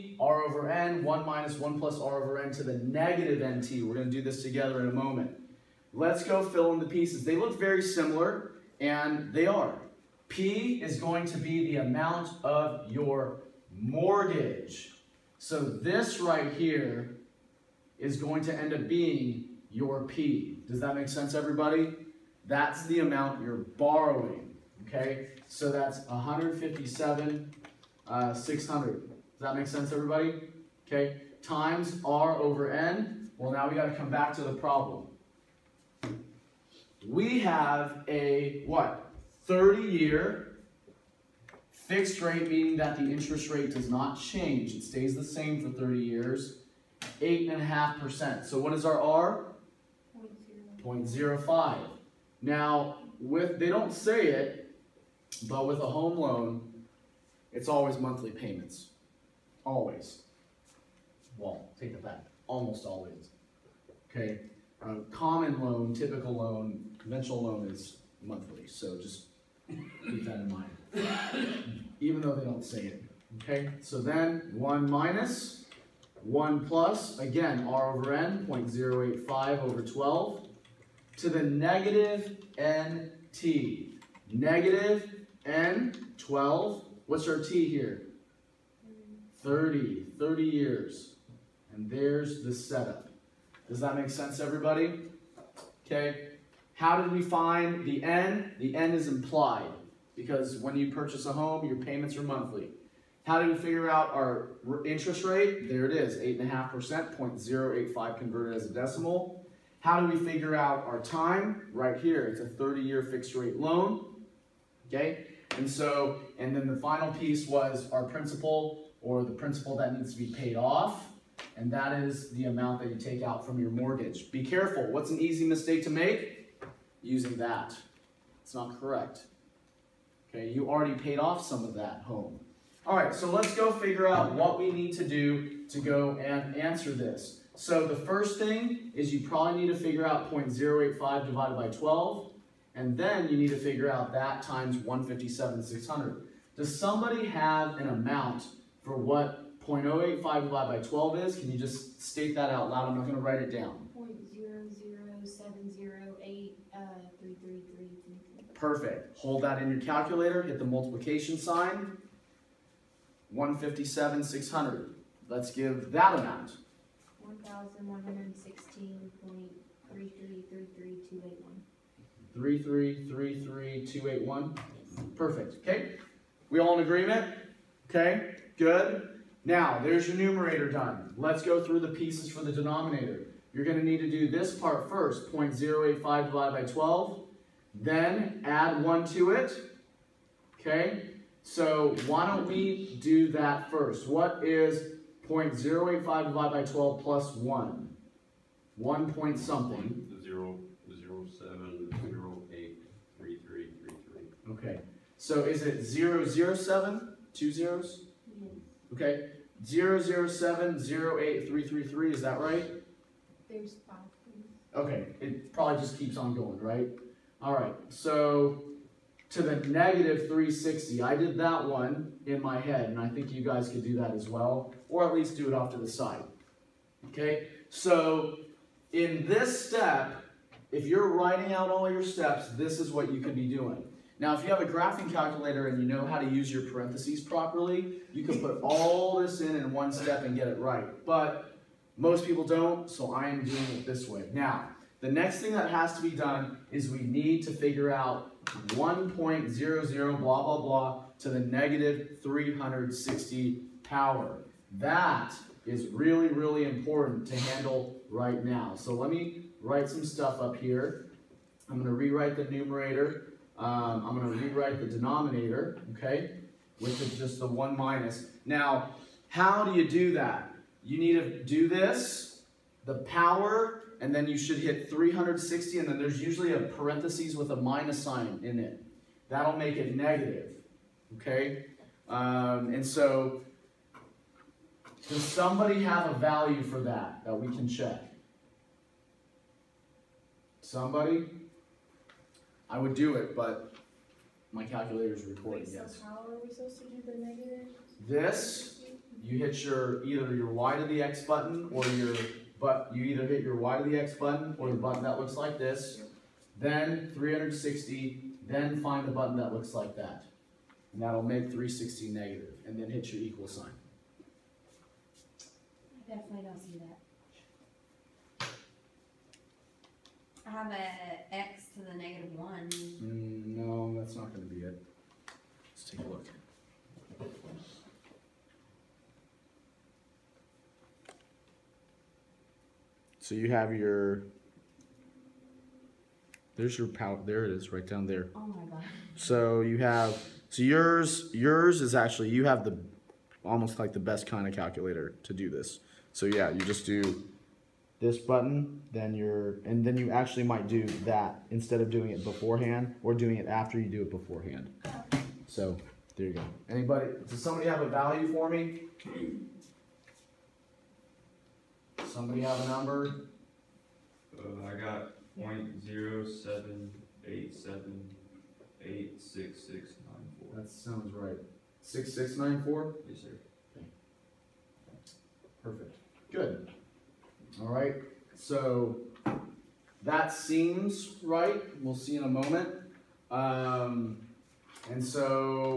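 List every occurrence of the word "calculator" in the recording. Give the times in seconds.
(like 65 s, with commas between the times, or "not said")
159 s, 235 s, 294 s, 344 s.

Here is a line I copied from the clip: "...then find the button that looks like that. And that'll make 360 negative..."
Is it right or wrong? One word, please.
right.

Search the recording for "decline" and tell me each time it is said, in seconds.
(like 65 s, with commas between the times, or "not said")
not said.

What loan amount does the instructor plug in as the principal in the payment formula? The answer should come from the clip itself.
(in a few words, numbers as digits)
157,600.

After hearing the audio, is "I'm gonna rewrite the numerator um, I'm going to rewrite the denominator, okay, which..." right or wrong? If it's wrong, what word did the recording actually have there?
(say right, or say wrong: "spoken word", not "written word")
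right.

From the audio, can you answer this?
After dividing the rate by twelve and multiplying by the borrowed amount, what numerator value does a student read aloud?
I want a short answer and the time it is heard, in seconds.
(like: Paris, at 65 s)
1,116.3333281, at 167 s.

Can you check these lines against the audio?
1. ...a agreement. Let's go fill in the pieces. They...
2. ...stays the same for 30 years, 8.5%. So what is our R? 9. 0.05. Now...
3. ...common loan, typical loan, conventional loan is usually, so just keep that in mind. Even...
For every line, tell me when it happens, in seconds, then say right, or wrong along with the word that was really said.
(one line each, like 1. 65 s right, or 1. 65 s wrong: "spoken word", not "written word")
1. 4 s wrong: "moment", not "agreement"
2. 44 s wrong: "0", not "9"
3. 65 s wrong: "monthly", not "usually".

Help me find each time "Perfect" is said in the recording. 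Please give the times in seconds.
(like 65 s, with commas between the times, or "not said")
158 s, 175 s, 375 s.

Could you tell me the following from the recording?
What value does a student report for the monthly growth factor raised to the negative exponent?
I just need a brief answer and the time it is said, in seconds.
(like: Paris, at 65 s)
0.07878694, at 365 s.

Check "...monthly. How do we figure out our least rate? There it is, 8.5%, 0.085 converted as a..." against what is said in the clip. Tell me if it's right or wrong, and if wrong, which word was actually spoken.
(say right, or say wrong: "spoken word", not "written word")
wrong: "interest", not "least".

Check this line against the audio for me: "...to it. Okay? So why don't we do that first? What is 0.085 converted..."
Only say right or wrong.
wrong.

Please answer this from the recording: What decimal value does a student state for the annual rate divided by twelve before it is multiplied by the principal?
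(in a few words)
0.007083333.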